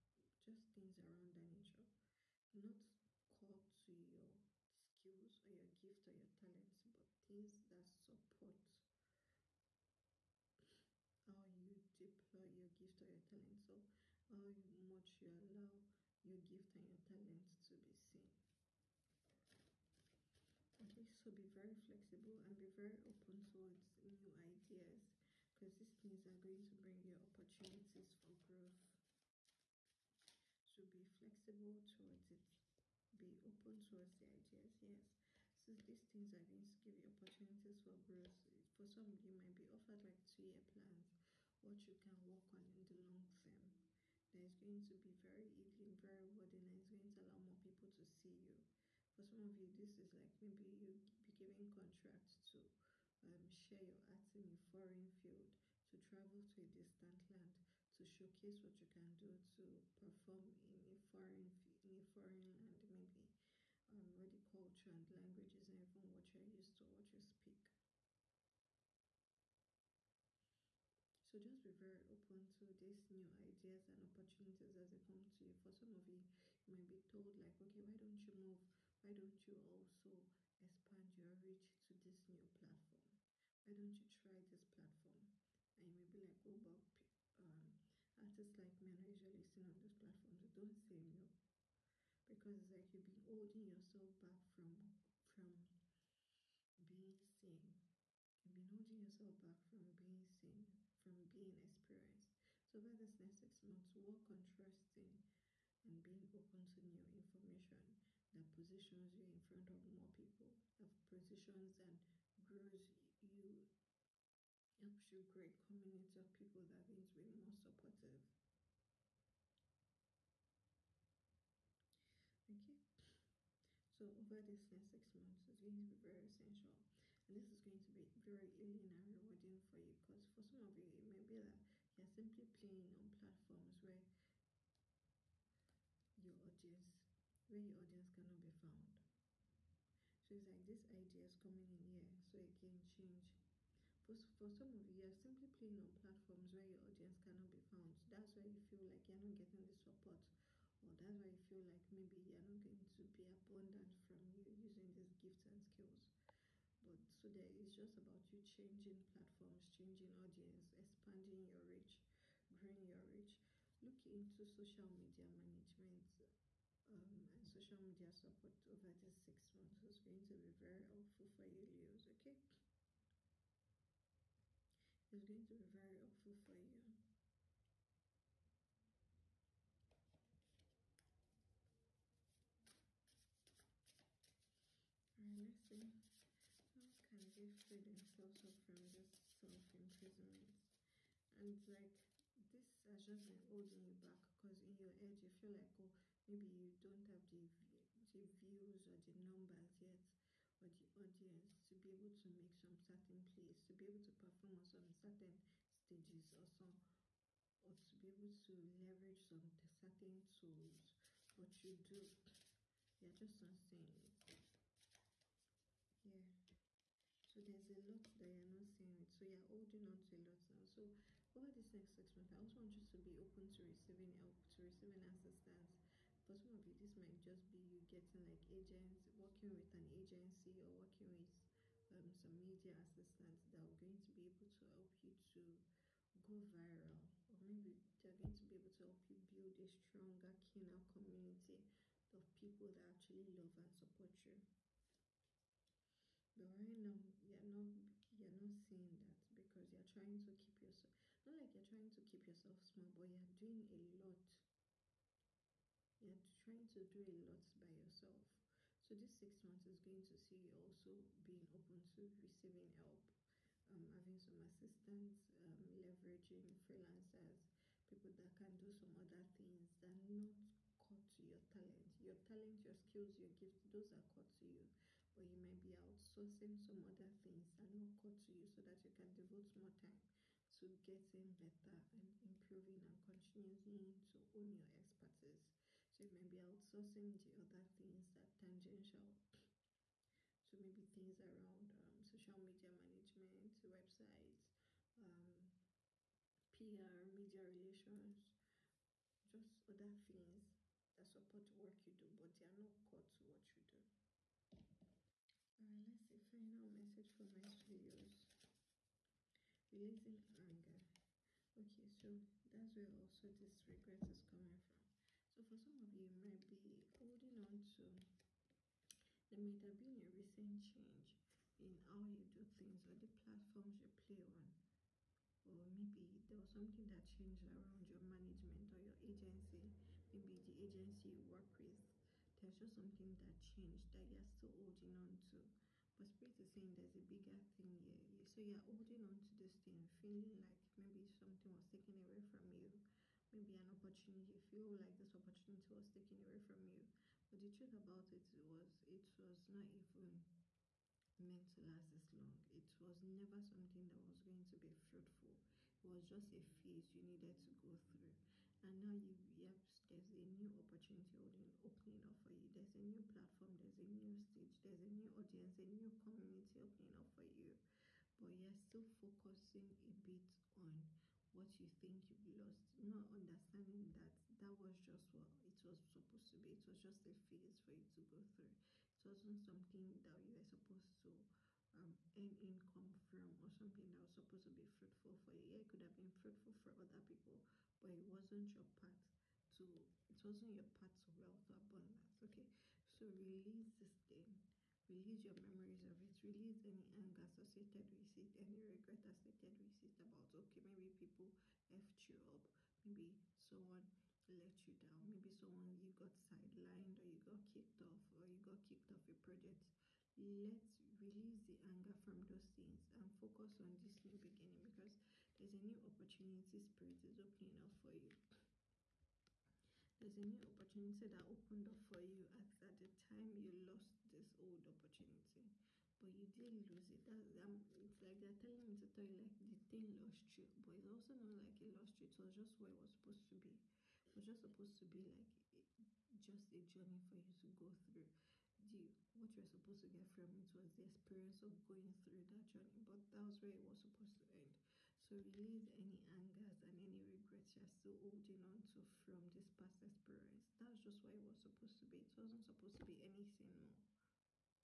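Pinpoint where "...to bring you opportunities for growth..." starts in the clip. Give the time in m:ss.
0:26.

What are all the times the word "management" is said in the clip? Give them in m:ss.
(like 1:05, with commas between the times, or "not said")
2:45, 4:52, 5:27.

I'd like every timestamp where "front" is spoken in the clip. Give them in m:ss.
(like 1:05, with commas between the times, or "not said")
1:49.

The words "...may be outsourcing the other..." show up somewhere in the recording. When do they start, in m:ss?
4:46.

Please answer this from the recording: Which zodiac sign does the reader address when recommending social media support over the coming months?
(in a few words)
Leos.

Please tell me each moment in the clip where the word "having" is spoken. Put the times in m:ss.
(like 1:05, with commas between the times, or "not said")
4:23.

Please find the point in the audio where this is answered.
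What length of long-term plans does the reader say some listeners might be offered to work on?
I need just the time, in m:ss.
0:40.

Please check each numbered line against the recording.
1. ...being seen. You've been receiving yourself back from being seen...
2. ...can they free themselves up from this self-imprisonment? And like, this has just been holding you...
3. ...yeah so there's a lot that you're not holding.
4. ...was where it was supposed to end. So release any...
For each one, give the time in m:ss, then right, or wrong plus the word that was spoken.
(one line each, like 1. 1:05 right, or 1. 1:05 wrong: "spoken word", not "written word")
1. 1:36 wrong: "holding", not "receiving"
2. 3:07 right
3. 3:36 wrong: "seeing", not "holding"
4. 7:23 right.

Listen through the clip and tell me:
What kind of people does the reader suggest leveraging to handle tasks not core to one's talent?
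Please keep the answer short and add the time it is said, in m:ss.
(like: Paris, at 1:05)
Freelancers, at 4:26.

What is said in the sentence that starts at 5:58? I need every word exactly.
And now you yep, there's a new opportunity opening up for you.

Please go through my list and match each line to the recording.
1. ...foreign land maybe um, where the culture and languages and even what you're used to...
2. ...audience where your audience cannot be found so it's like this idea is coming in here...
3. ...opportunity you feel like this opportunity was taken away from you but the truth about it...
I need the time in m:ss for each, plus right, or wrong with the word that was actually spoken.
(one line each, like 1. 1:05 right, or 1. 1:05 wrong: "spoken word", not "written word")
1. 1:02 right
2. 2:16 right
3. 5:43 right.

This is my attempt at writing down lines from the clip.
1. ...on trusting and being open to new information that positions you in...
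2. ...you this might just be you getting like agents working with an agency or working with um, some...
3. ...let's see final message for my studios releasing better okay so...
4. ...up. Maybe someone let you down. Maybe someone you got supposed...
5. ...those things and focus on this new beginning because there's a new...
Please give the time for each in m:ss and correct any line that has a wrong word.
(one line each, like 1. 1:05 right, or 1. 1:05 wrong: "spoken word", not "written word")
1. 1:44 right
2. 3:46 right
3. 5:05 wrong: "anger", not "better"
4. 6:42 wrong: "sidelined", not "supposed"
5. 6:52 right.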